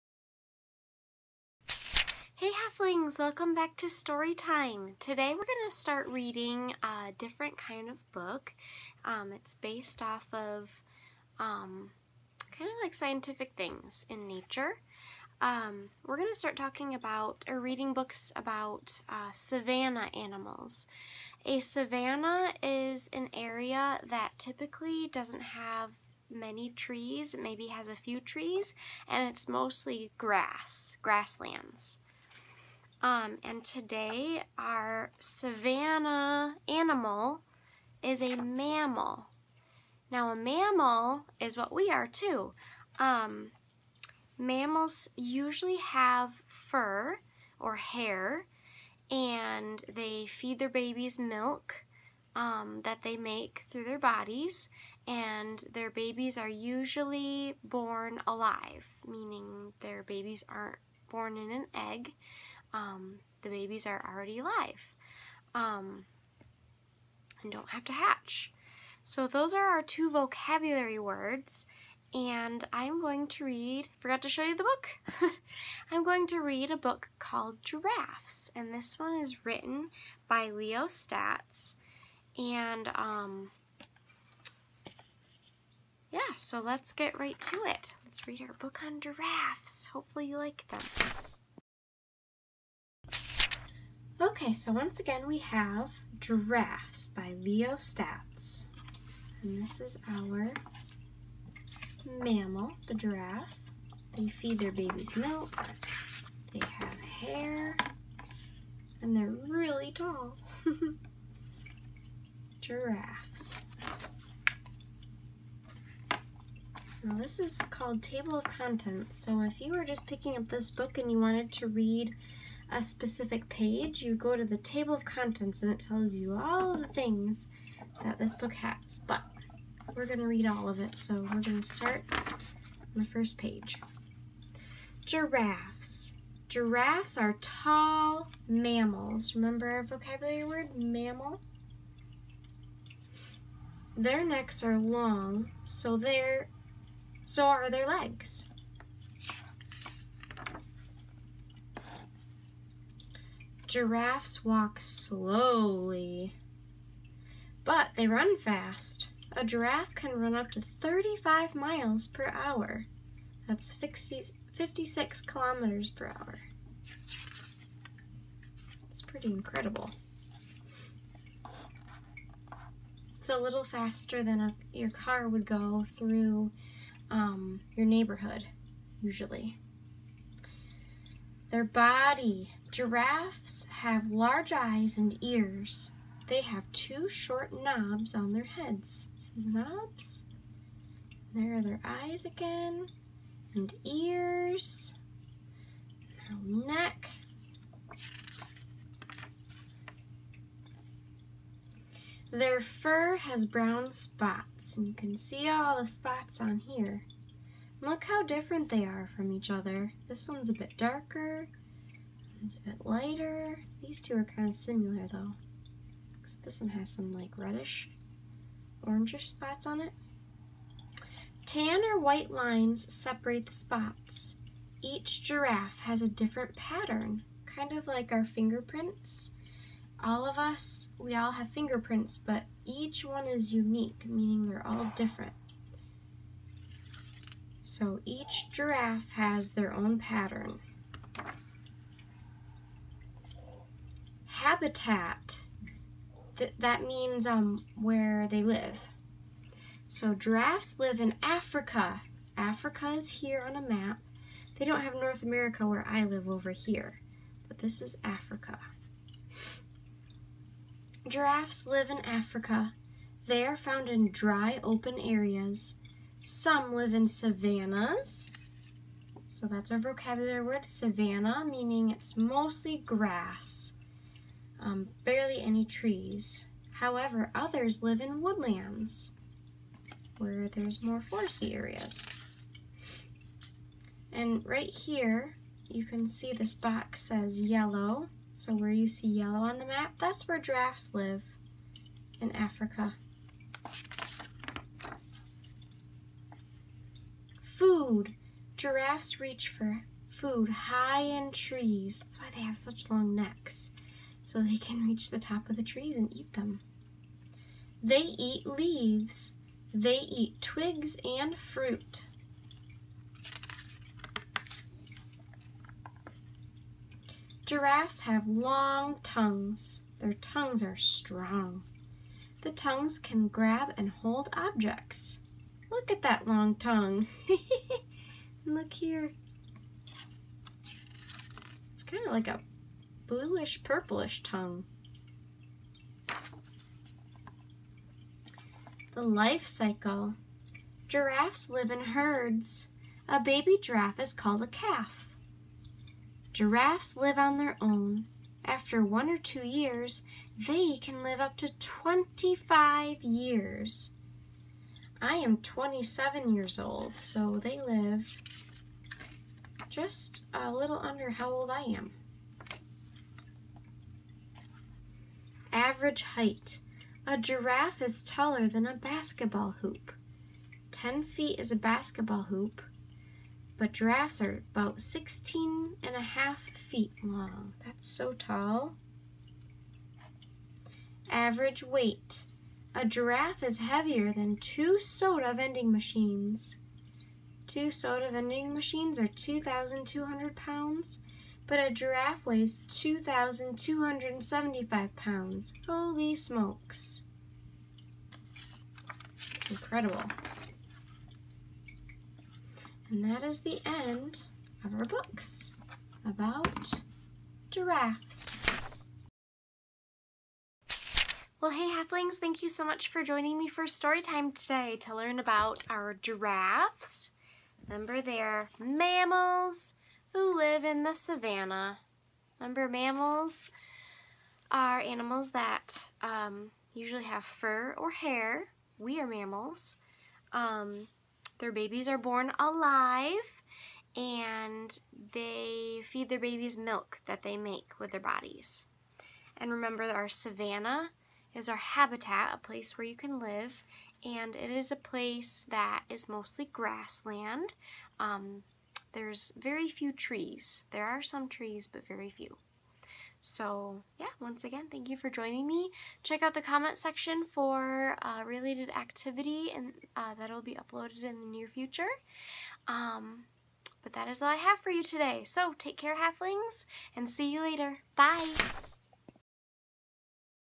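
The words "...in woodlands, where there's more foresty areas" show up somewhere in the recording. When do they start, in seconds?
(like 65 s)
278 s.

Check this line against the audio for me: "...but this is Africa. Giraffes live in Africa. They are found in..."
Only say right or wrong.
right.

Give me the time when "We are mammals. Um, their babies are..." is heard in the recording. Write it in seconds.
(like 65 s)
428 s.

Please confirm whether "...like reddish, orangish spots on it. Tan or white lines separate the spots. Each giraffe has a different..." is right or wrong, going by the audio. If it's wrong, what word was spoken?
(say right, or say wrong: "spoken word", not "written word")
right.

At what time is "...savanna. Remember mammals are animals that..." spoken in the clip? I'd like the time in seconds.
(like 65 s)
420 s.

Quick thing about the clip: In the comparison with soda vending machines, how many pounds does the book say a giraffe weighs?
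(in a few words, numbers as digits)
2,275 pounds.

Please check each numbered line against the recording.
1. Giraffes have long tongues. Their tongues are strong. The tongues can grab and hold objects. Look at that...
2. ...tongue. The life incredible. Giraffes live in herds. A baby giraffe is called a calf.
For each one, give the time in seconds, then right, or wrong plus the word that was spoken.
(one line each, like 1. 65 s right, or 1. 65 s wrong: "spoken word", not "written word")
1. 317 s right
2. 334 s wrong: "cycle", not "incredible".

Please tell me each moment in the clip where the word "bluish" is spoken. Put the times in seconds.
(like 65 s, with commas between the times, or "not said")
333 s.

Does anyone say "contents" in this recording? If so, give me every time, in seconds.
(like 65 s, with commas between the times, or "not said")
118 s, 125 s.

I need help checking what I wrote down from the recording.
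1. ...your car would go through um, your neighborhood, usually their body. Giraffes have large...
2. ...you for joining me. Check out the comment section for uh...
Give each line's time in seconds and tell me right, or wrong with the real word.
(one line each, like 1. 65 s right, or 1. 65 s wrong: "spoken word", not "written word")
1. 174 s right
2. 454 s right.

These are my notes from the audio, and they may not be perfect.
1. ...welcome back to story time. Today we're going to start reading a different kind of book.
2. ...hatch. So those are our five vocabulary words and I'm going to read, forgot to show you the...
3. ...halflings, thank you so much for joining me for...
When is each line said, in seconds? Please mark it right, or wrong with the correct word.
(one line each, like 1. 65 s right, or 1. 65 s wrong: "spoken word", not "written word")
1. 3 s right
2. 67 s wrong: "two", not "five"
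3. 411 s right.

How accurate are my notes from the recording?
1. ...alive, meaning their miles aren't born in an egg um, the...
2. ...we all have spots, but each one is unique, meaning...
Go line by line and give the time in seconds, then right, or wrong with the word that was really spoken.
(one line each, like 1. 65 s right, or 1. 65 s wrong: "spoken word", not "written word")
1. 58 s wrong: "babies", not "miles"
2. 230 s wrong: "fingerprints", not "spots".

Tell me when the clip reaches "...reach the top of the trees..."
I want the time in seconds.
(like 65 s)
304 s.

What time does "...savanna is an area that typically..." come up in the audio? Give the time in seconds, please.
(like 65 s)
21 s.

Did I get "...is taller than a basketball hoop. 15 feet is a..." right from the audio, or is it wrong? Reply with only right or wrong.
wrong.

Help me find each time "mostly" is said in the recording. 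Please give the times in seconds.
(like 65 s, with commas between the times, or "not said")
29 s, 272 s, 446 s.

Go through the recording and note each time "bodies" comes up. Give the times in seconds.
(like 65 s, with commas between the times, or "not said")
53 s, 437 s.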